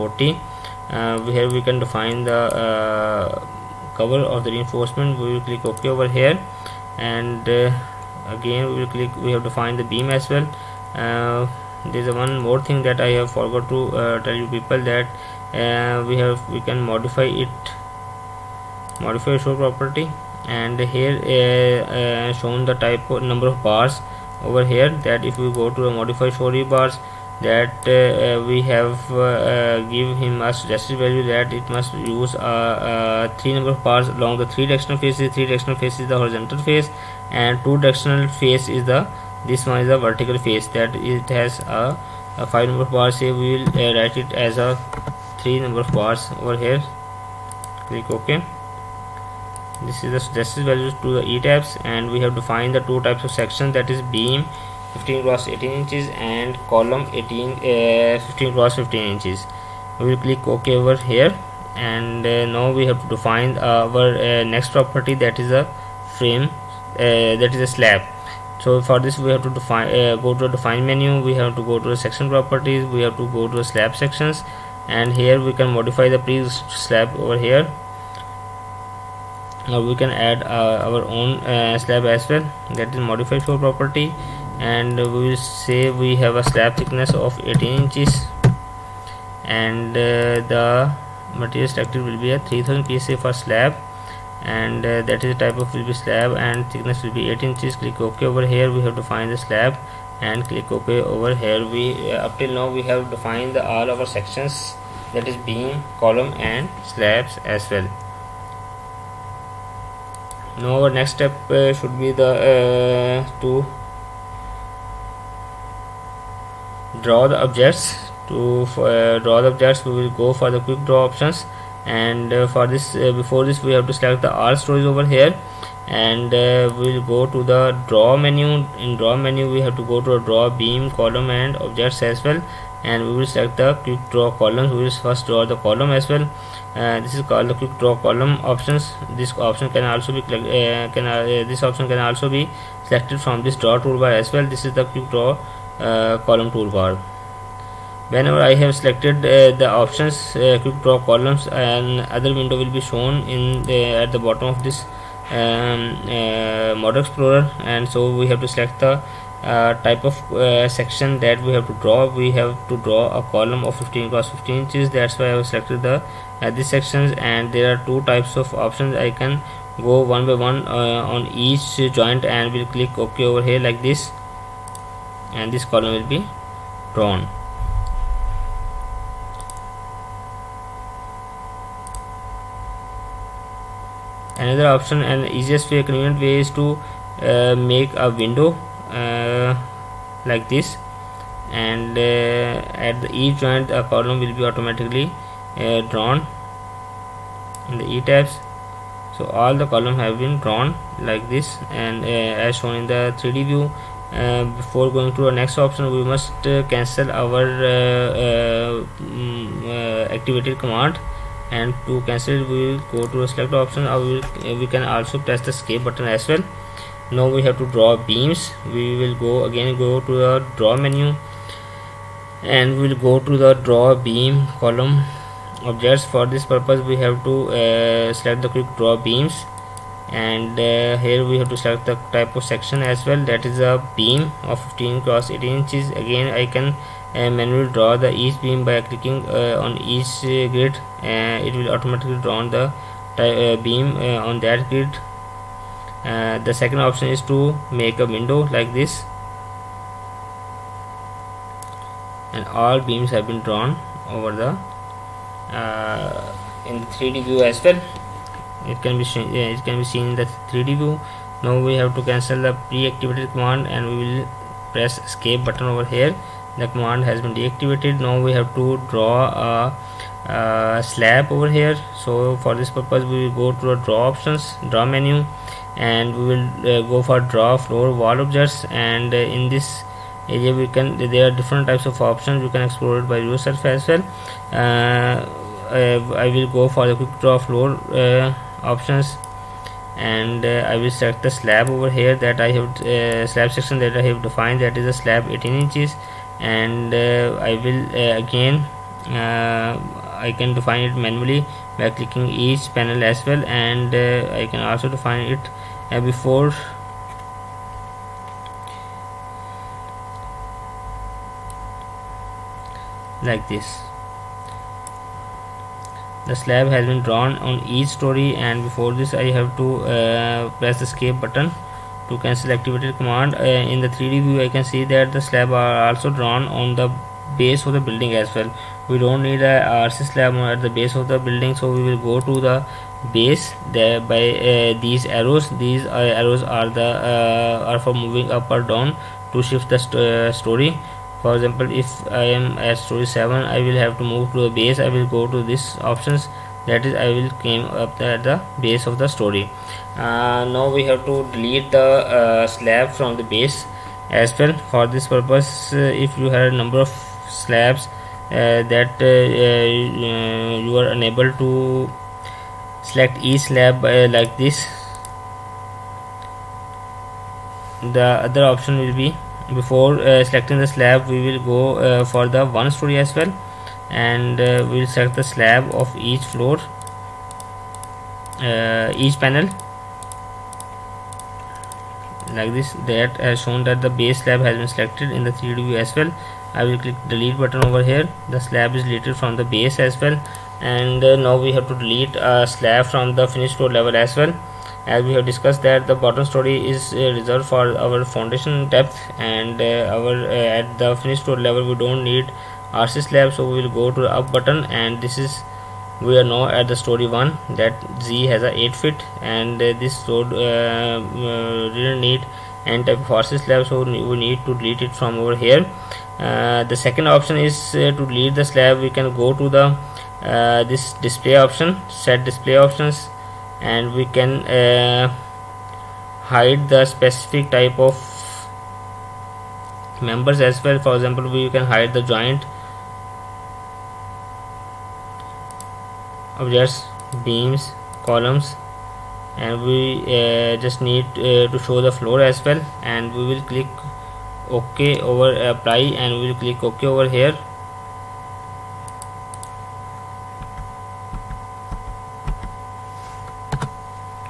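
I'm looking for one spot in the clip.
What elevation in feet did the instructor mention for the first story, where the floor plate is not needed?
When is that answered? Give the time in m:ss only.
6:48.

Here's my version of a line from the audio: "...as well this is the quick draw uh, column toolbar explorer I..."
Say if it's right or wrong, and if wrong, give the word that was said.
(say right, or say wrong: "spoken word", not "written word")
wrong: "whenever", not "explorer".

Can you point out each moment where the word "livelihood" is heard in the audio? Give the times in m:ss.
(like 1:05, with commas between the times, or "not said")
not said.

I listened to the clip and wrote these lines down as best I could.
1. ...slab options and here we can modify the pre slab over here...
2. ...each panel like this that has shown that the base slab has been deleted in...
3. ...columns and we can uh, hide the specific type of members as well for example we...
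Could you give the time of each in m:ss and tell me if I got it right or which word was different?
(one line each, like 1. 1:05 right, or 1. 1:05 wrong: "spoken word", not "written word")
1. 1:13 wrong: "sections", not "options"
2. 6:18 wrong: "selected", not "deleted"
3. 7:02 wrong: "options", not "columns".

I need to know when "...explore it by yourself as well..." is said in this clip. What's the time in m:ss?
4:42.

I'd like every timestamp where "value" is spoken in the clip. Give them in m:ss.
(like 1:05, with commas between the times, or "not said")
0:30, 0:50.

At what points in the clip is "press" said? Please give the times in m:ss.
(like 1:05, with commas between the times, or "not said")
3:35, 4:24, 5:20.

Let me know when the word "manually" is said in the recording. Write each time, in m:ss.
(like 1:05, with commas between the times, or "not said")
3:57, 5:00.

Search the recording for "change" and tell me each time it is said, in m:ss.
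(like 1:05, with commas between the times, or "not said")
not said.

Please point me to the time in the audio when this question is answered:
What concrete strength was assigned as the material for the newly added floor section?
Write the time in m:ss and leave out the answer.
1:32.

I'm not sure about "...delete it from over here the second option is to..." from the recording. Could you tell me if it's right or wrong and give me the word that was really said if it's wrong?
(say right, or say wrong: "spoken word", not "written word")
right.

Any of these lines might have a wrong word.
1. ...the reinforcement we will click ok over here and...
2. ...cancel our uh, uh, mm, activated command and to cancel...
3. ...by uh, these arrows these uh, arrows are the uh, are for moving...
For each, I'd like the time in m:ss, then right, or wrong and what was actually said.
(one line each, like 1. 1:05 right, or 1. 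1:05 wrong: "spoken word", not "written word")
1. 0:04 right
2. 3:26 right
3. 5:33 right.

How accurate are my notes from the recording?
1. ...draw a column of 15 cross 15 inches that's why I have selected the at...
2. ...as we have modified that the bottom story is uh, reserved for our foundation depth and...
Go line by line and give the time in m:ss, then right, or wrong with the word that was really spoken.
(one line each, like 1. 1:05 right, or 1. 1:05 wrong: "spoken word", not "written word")
1. 2:42 right
2. 6:34 wrong: "discussed", not "modified".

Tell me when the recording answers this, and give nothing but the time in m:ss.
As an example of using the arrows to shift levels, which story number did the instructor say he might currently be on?
5:42.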